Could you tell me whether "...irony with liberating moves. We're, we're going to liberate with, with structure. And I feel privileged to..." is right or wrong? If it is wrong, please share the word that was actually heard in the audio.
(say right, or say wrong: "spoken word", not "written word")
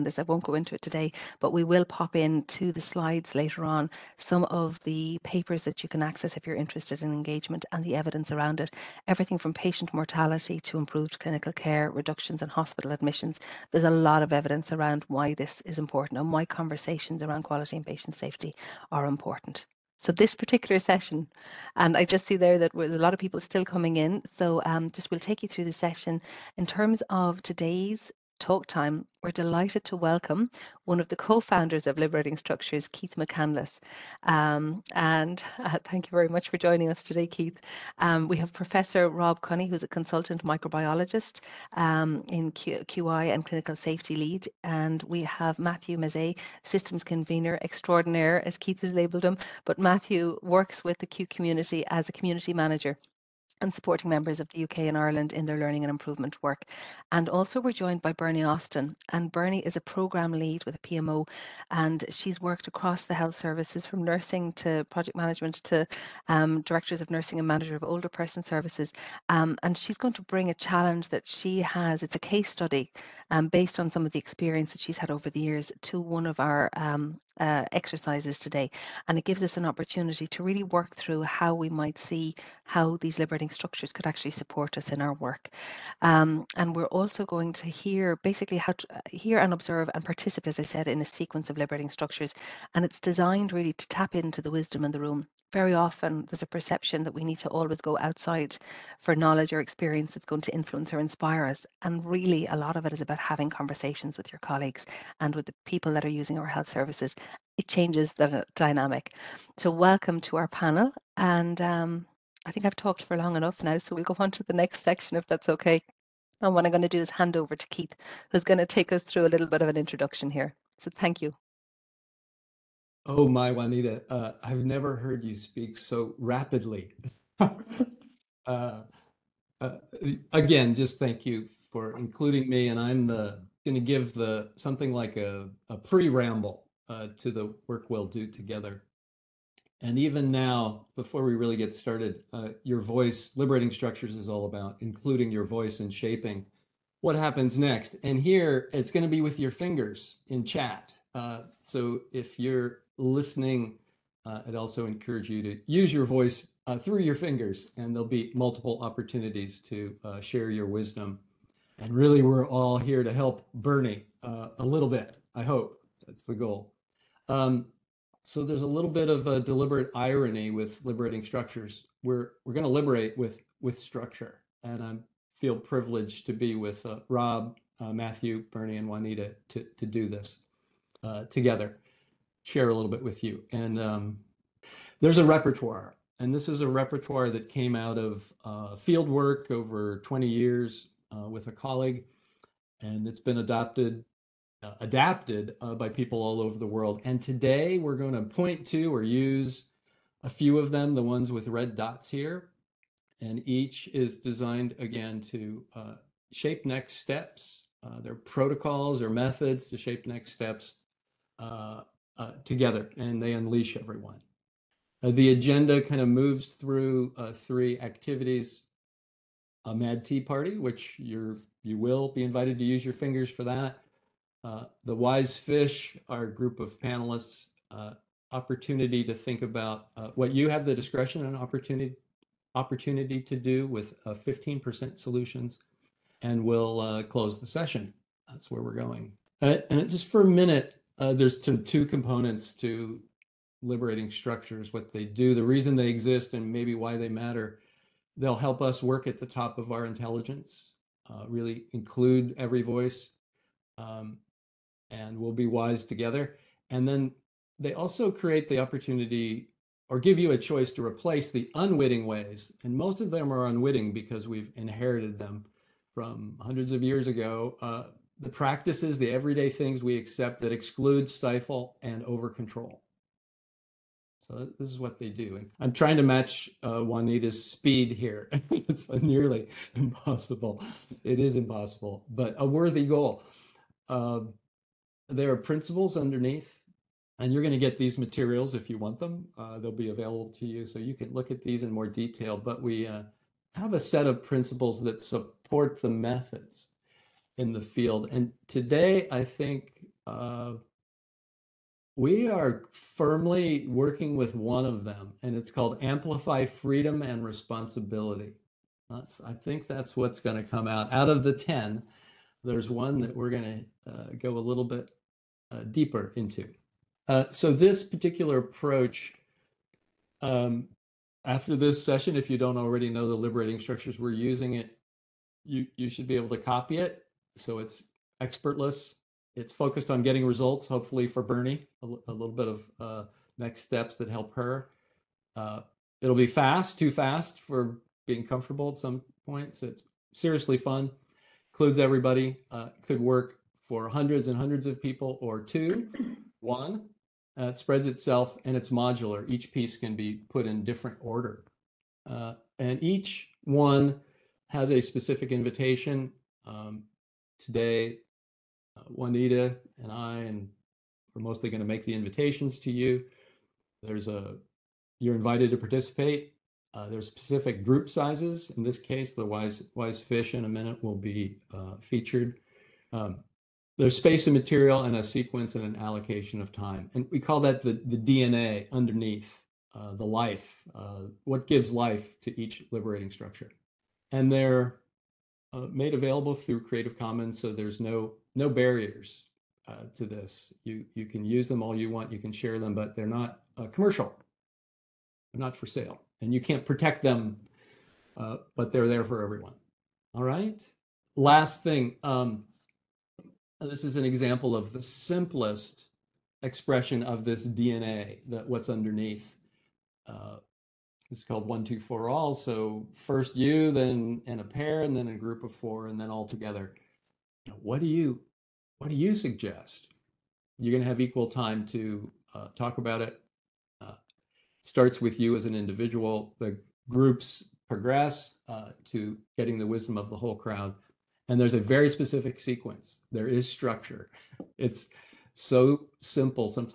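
wrong: "structures", not "moves".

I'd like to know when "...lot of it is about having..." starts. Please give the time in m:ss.
1:42.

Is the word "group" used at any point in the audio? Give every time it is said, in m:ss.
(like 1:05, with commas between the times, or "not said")
3:46, 6:07, 6:55, 7:06.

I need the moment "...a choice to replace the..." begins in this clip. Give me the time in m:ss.
4:20.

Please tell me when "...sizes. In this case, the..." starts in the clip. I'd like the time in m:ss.
6:07.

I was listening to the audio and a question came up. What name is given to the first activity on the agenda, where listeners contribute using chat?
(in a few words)
mad tea party.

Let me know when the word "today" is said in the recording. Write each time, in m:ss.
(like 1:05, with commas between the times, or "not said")
0:00, 0:27, 0:37, 1:18, 3:17, 4:58, 5:57.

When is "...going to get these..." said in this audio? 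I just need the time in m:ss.
4:47.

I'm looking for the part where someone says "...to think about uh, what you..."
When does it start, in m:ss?
3:49.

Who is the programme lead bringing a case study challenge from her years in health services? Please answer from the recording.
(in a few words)
Bernie Austin.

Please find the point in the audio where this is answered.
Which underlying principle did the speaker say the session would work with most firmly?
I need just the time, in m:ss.
5:05.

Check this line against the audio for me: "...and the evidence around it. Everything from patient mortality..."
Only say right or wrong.
right.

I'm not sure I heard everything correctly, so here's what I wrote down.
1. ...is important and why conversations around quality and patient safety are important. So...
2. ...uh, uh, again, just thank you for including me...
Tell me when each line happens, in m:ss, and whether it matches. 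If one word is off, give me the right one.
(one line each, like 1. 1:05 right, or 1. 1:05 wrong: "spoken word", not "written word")
1. 0:15 right
2. 2:07 right.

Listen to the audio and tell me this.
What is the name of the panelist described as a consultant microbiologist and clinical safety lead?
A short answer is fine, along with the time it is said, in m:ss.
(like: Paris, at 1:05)
Rob Cunney, at 0:39.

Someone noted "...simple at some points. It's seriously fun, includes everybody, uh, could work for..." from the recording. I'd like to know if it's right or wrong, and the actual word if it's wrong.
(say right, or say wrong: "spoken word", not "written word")
wrong: "comfortable", not "simple".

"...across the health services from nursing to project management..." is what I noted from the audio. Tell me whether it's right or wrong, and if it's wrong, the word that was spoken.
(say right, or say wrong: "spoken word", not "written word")
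right.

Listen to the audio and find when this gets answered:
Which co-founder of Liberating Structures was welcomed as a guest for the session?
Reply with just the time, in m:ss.
0:32.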